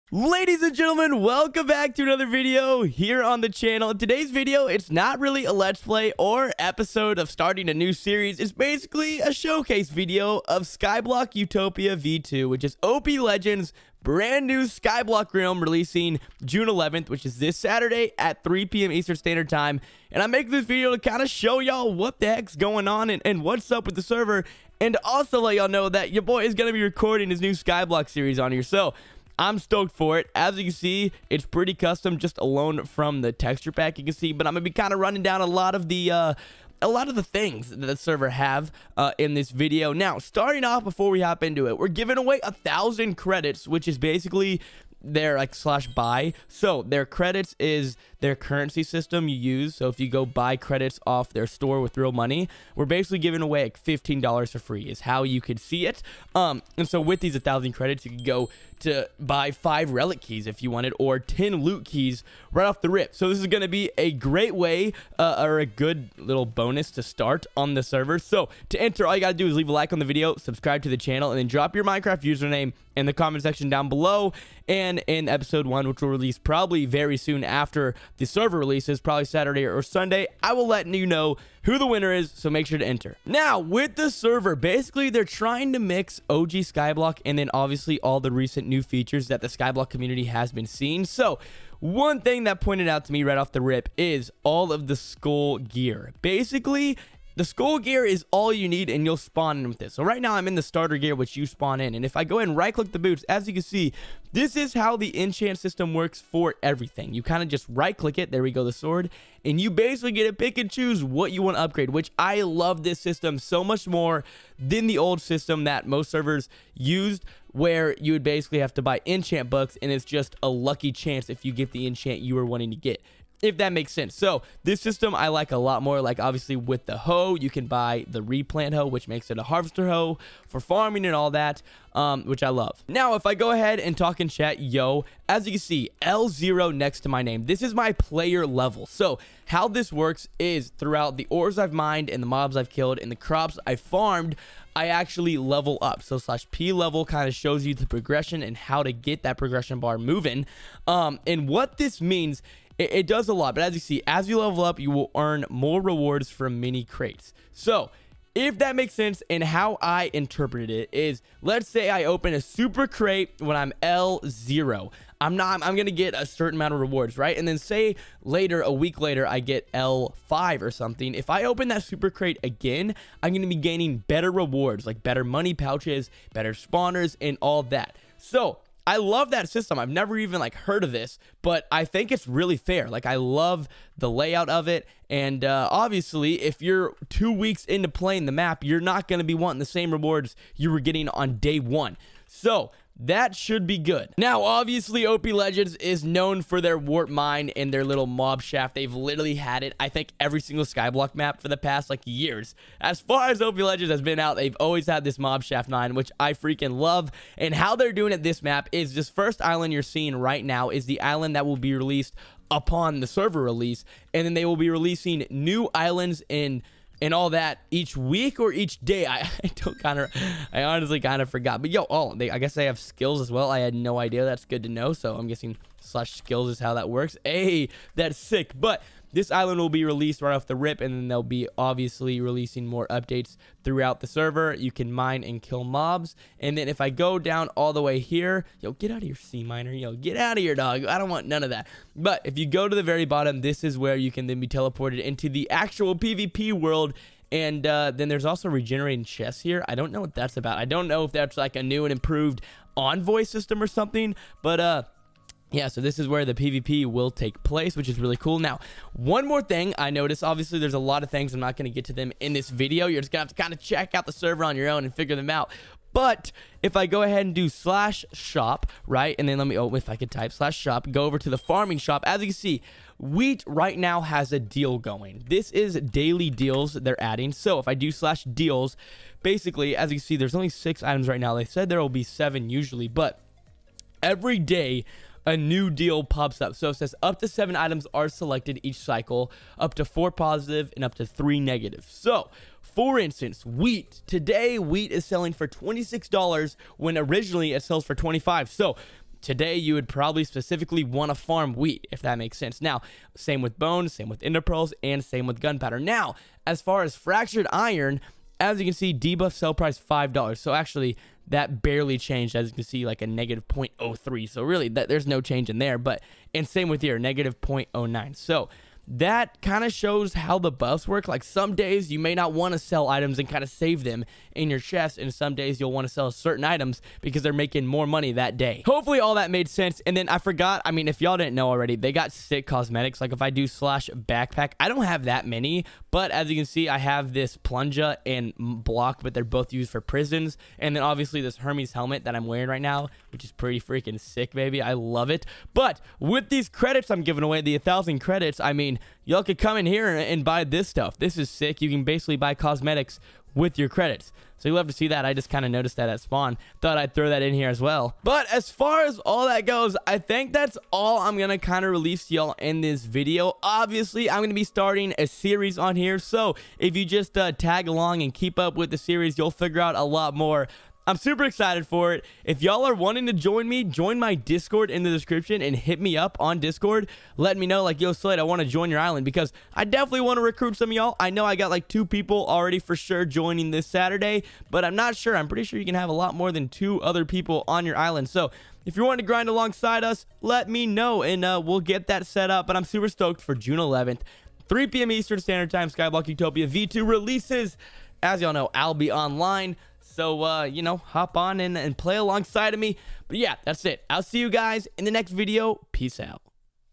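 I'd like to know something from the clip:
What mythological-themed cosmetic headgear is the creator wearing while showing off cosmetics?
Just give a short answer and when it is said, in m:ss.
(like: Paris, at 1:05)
Hermes helmet, at 5:41.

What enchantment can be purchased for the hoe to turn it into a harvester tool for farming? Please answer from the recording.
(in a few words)
Replant.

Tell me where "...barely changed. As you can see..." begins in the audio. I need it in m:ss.
5:11.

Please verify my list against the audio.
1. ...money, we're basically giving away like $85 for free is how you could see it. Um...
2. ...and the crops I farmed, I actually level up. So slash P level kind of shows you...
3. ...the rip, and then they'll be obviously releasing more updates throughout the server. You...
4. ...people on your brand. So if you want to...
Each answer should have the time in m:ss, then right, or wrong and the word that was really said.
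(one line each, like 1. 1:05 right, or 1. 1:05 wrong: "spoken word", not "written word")
1. 0:52 wrong: "15", not "85"
2. 2:23 right
3. 3:50 right
4. 6:27 wrong: "island", not "brand".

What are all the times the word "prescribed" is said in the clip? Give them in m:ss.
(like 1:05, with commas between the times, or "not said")
not said.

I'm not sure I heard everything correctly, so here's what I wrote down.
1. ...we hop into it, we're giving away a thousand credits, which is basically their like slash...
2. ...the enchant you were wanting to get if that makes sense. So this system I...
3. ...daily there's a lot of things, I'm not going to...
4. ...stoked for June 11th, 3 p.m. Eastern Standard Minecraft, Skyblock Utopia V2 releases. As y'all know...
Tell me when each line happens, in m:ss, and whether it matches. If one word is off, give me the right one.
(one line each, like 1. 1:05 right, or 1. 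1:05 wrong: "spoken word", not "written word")
1. 0:41 right
2. 2:01 right
3. 4:20 wrong: "obviously", not "daily"
4. 6:32 wrong: "Time", not "Minecraft".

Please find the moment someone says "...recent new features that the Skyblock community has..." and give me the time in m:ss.
1:28.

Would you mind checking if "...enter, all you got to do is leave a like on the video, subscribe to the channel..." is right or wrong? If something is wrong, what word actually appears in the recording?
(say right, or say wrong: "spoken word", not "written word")
right.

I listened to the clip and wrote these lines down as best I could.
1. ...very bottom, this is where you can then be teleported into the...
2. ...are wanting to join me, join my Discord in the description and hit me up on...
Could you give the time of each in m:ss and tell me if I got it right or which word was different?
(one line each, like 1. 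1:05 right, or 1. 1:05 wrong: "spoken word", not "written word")
1. 4:02 right
2. 6:12 right.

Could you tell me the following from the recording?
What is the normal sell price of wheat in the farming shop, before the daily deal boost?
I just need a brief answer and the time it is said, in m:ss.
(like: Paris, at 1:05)
$25, at 4:56.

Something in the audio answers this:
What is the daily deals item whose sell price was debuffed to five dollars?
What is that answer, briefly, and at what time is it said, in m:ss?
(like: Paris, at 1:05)
Fractured iron, at 5:06.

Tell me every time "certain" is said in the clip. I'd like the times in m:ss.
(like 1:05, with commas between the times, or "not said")
2:46, 5:26.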